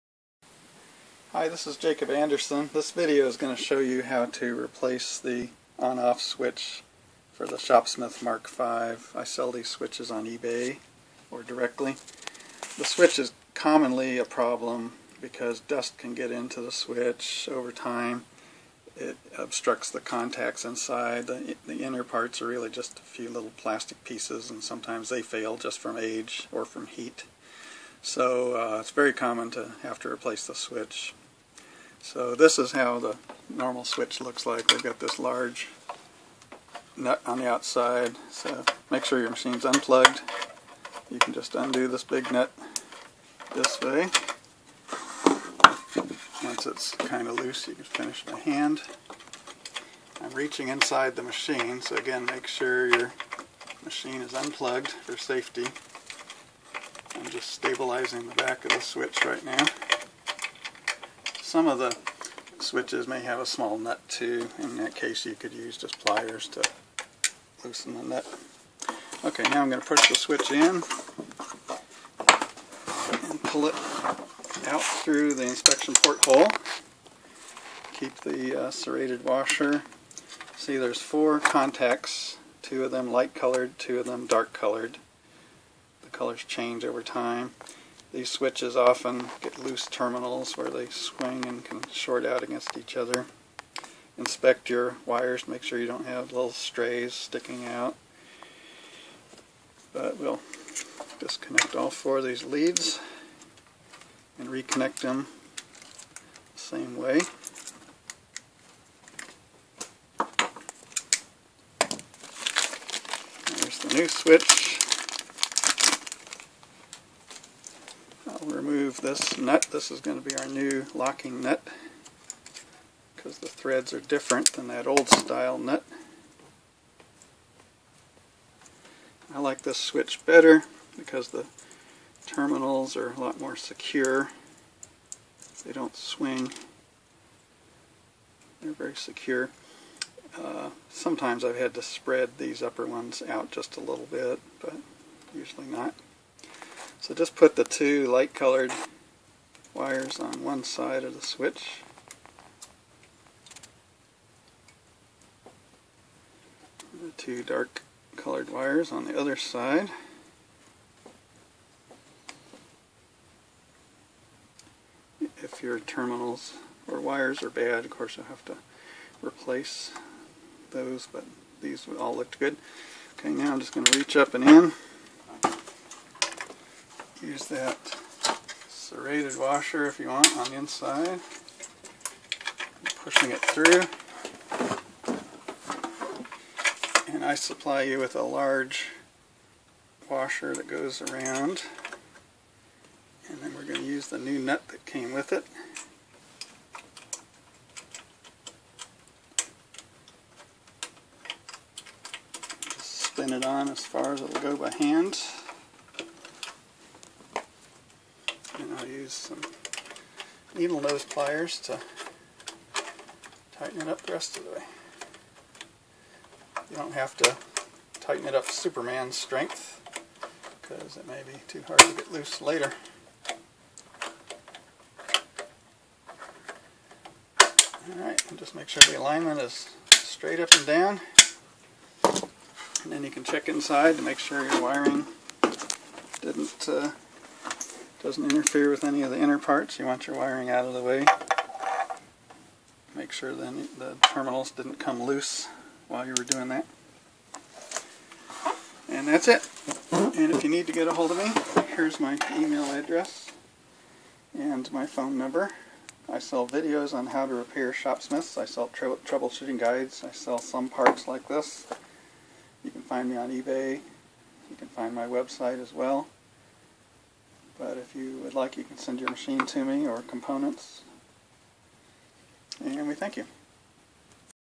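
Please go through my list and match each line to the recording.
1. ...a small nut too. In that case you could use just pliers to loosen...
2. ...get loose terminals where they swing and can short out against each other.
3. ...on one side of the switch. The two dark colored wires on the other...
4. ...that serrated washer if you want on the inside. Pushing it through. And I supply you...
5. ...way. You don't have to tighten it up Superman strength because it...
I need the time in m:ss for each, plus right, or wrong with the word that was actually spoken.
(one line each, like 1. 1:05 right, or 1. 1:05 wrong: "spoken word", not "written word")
1. 1:03 right
2. 1:29 right
3. 2:30 right
4. 2:57 right
5. 3:34 right.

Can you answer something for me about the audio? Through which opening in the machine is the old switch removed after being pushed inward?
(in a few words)
inspection port hole.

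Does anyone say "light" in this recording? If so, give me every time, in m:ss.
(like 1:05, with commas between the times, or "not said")
1:23, 2:28.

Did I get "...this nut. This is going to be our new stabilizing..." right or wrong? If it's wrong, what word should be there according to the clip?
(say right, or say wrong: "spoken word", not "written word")
wrong: "locking", not "stabilizing".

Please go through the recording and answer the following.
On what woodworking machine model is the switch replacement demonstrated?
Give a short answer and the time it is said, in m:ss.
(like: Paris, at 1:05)
ShopSmith Mark V, at 0:07.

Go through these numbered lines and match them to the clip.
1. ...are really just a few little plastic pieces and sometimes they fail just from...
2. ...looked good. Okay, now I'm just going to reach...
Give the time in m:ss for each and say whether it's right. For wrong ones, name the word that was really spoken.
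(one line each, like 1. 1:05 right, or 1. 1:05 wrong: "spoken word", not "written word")
1. 0:22 right
2. 2:52 right.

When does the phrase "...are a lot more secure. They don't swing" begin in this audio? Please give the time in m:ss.
2:12.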